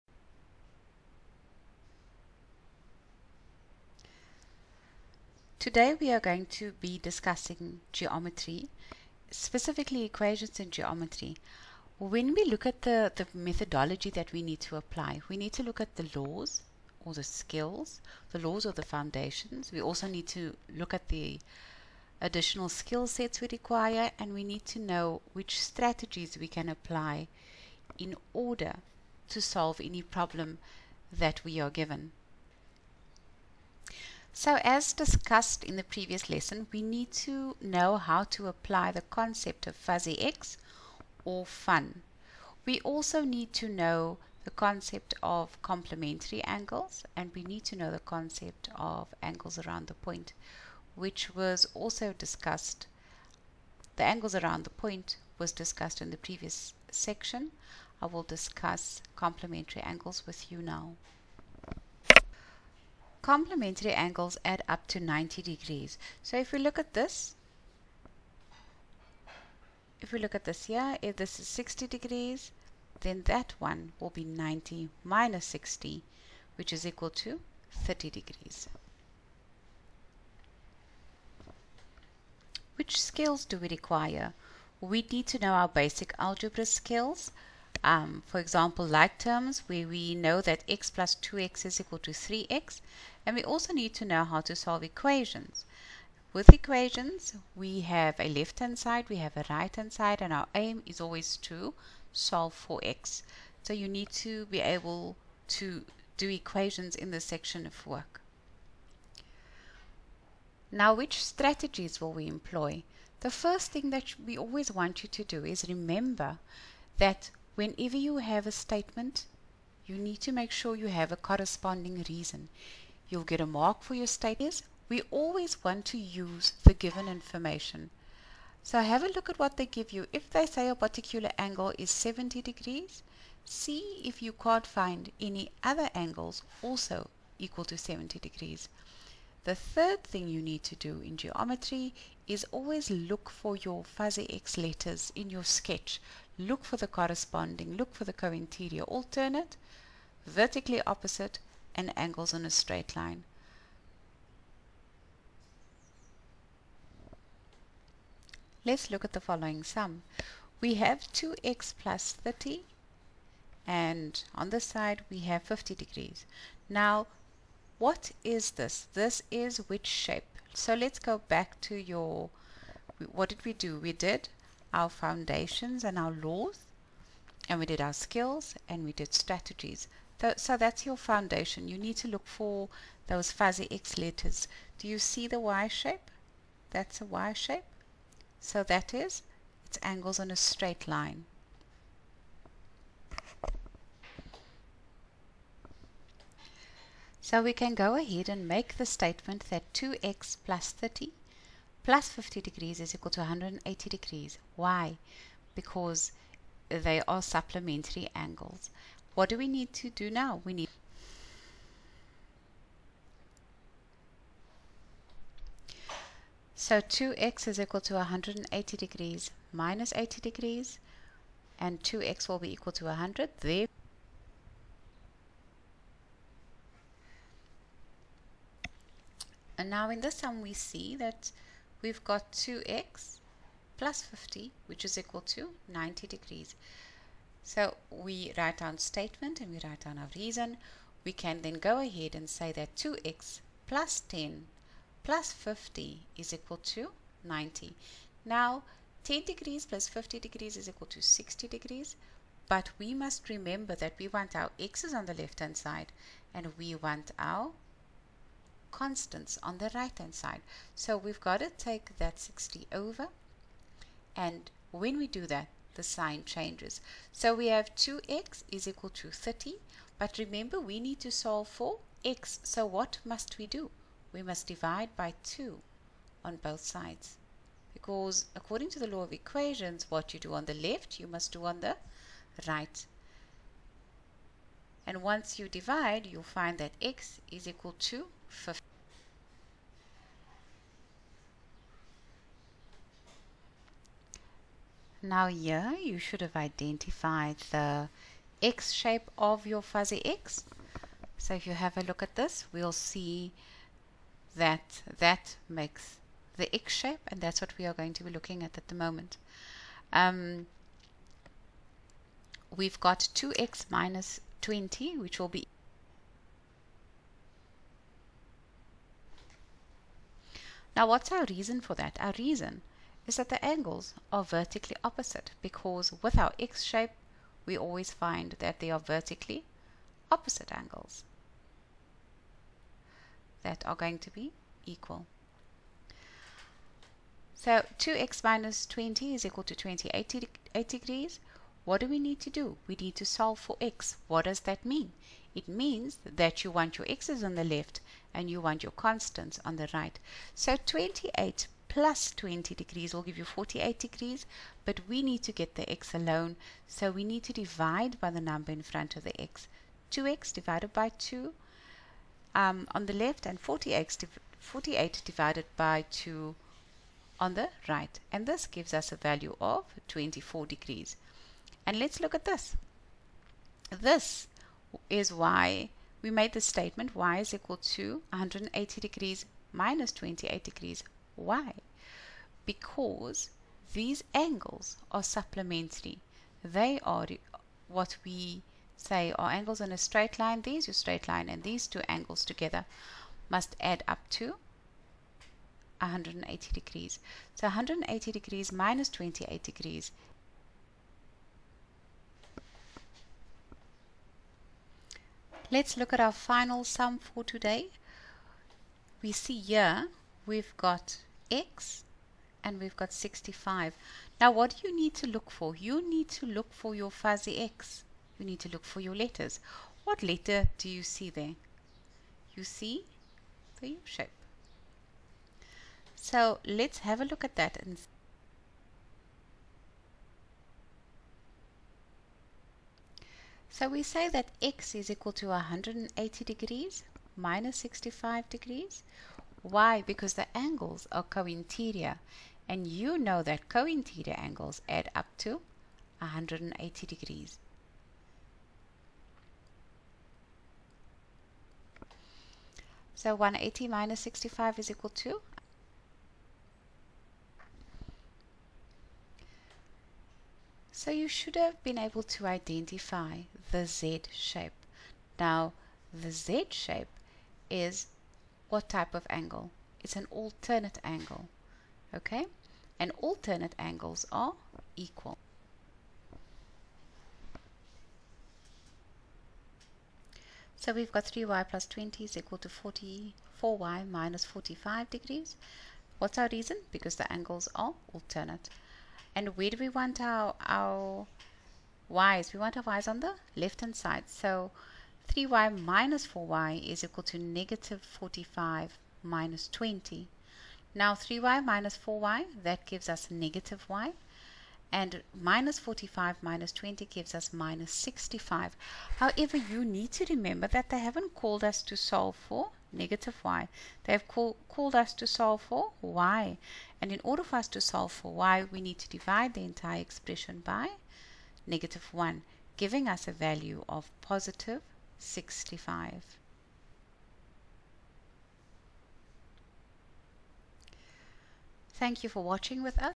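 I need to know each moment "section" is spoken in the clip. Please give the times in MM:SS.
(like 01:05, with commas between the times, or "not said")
00:56, 01:47.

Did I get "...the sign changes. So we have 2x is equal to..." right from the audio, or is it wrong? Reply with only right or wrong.
right.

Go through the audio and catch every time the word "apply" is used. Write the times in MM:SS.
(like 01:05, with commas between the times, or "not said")
00:14, 00:26, 00:38.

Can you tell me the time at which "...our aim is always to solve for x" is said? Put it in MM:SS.
01:40.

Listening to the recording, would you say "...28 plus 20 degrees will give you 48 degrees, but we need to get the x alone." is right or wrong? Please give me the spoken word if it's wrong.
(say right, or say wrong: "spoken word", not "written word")
right.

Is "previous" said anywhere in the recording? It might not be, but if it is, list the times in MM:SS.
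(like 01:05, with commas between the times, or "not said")
00:35, 00:56.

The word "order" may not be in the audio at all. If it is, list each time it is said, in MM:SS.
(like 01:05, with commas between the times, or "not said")
00:28, 08:37.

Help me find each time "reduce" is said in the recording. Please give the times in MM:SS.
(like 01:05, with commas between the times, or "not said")
not said.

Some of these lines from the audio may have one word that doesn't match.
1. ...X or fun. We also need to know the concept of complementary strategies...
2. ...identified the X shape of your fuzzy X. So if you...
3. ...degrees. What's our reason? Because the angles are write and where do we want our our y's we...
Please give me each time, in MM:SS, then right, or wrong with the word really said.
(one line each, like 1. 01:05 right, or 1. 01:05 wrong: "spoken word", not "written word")
1. 00:40 wrong: "angles", not "strategies"
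2. 04:56 right
3. 08:04 wrong: "alternate", not "write".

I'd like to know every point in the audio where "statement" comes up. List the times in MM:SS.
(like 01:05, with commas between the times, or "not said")
01:58, 02:04, 03:18, 03:58, 06:16.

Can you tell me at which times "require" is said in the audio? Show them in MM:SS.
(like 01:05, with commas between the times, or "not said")
00:23, 01:23.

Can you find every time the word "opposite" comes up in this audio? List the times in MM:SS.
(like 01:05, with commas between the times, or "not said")
02:30, 05:24, 05:30.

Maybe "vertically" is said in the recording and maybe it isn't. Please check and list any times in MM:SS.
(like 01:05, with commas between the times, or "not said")
02:30, 05:24, 05:28.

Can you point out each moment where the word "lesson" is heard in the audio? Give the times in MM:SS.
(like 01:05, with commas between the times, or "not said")
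00:36.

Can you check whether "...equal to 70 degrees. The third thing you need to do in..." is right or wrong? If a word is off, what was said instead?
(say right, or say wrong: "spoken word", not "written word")
right.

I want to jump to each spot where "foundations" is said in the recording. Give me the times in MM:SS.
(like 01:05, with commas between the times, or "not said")
00:18, 02:54, 03:00.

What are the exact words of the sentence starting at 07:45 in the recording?
Now the Z shape is what type of angle?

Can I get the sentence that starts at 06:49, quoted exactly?
We see here we've got x and we've got 65.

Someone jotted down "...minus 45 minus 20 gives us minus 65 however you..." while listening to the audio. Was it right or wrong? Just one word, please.
right.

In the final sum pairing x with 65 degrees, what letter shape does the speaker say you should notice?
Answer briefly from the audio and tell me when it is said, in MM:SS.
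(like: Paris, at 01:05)
U shape, at 07:03.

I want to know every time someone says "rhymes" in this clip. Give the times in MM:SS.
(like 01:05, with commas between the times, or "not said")
not said.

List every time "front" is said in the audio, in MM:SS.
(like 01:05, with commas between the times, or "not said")
05:58.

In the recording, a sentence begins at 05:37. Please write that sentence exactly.
So 2x minus 20 is equal to 28 degrees.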